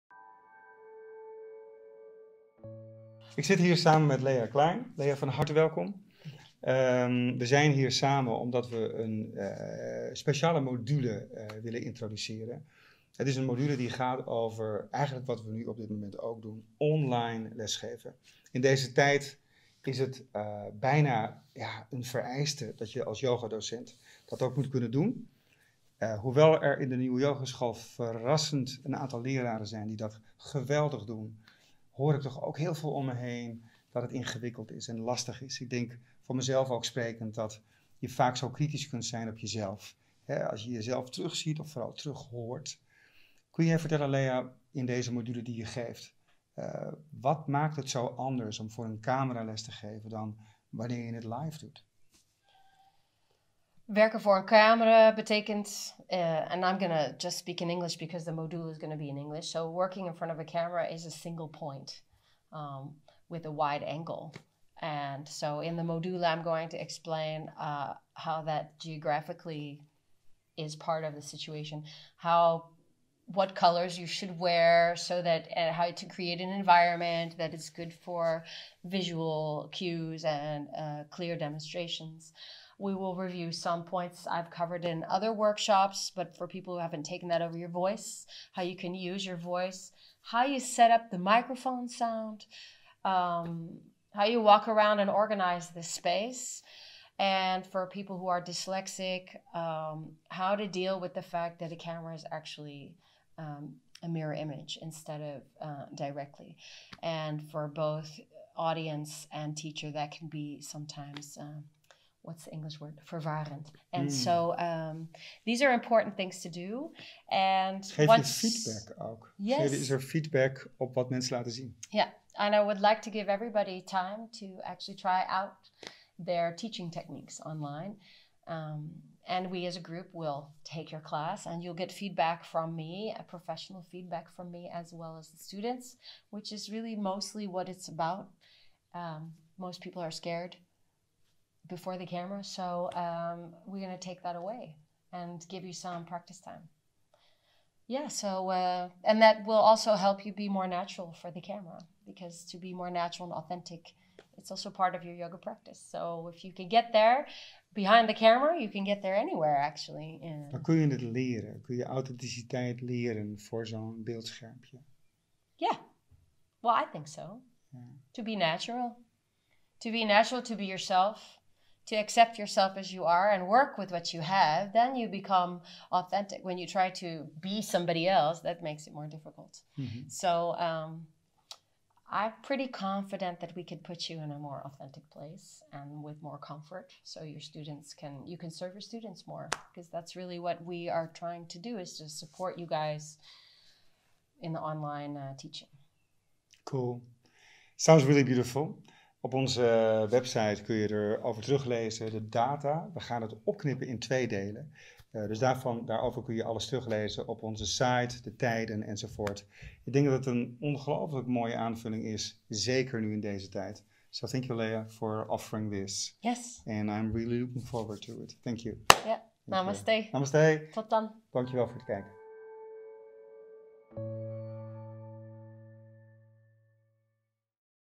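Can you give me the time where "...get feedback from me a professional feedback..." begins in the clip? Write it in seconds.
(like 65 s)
131 s.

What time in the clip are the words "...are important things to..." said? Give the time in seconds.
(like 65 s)
115 s.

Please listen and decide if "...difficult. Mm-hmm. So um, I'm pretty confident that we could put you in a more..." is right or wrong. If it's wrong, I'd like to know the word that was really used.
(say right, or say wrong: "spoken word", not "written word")
right.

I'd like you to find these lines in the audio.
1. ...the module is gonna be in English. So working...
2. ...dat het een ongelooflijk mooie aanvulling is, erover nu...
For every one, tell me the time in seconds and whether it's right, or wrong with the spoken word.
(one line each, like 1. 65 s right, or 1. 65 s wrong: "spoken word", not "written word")
1. 58 s right
2. 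210 s wrong: "zeker", not "erover".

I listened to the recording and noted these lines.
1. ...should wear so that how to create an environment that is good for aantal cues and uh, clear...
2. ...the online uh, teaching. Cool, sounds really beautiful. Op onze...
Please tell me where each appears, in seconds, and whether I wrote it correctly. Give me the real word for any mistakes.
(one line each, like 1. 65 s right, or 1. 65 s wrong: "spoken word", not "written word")
1. 74 s wrong: "visual", not "aantal"
2. 194 s right.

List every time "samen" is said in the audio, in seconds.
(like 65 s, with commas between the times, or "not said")
3 s, 7 s.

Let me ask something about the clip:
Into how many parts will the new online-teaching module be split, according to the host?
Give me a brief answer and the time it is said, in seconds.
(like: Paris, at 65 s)
2, at 203 s.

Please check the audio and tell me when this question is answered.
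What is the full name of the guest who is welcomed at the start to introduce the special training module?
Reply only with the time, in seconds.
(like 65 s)
4 s.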